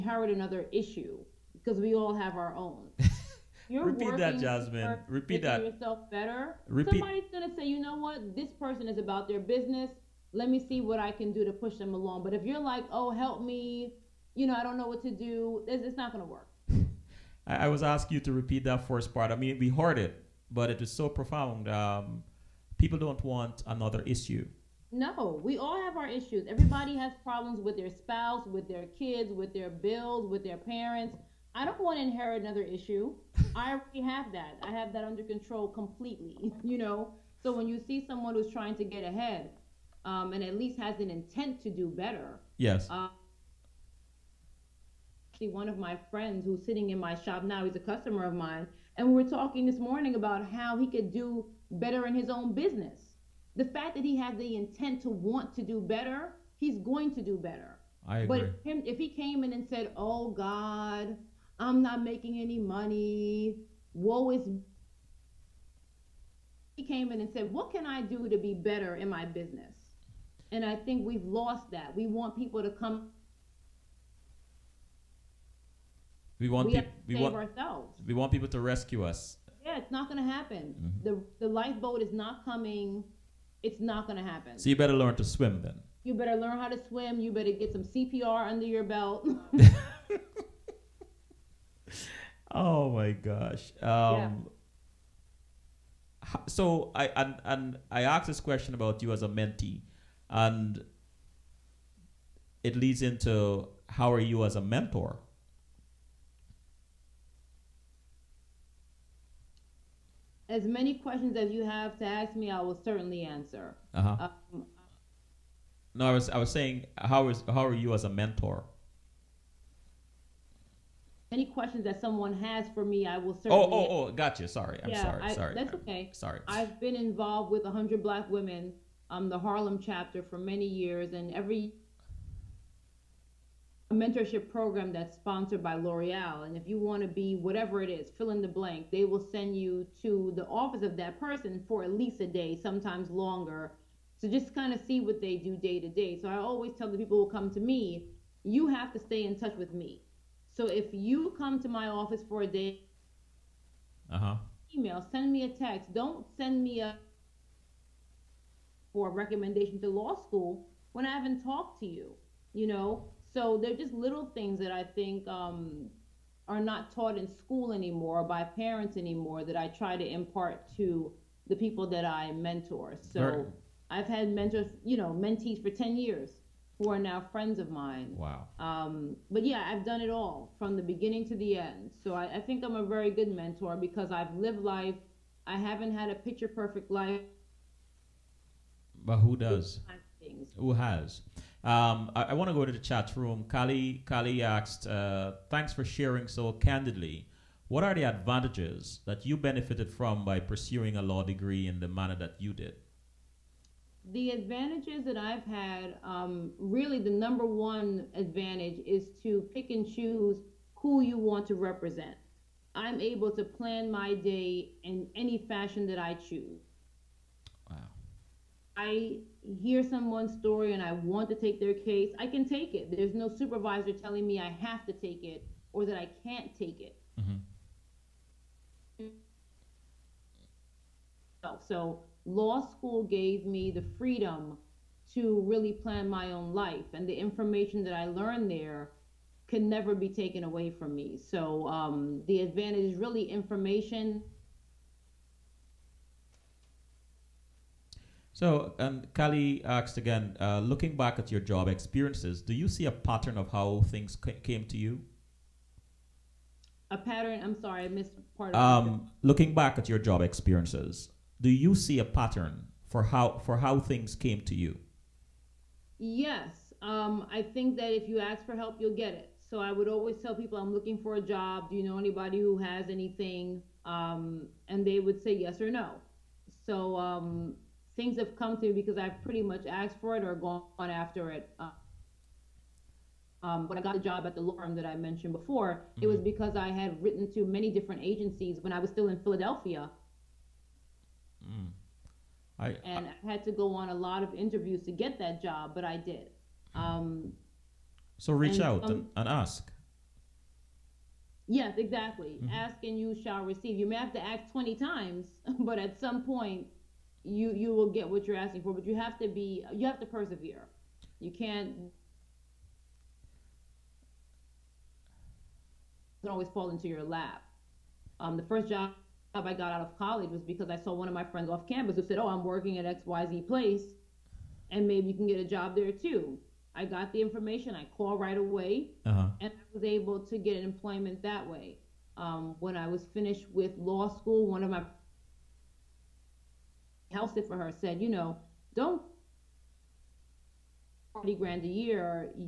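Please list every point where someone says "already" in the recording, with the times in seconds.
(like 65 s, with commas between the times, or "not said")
33 s.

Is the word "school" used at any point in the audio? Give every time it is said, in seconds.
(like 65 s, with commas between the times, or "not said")
160 s, 167 s, 232 s, 334 s.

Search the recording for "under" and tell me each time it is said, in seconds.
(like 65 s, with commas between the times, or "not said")
35 s, 88 s.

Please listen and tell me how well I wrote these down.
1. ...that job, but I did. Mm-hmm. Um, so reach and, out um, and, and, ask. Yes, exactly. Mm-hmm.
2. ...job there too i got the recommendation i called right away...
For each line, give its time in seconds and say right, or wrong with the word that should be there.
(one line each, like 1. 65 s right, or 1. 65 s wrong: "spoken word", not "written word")
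1. 295 s right
2. 325 s wrong: "information", not "recommendation".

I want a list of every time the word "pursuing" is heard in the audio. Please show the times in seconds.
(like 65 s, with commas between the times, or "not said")
200 s.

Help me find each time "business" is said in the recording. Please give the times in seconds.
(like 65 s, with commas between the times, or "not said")
9 s, 52 s, 69 s.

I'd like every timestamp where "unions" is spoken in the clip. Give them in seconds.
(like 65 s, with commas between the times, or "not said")
not said.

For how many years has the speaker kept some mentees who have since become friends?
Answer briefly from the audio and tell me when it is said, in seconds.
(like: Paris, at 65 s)
10, at 175 s.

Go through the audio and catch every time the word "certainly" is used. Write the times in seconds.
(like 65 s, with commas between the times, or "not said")
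112 s, 123 s.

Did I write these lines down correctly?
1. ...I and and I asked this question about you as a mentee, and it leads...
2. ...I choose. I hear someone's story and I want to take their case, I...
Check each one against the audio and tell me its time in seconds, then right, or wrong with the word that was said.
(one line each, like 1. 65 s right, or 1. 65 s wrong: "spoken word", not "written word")
1. 96 s right
2. 215 s right.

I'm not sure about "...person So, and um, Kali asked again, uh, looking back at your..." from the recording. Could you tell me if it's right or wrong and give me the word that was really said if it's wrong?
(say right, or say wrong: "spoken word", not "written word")
wrong: "information", not "person".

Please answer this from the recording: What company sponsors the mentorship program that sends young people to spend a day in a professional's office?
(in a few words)
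L'Oreal.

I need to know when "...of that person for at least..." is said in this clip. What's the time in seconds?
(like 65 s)
140 s.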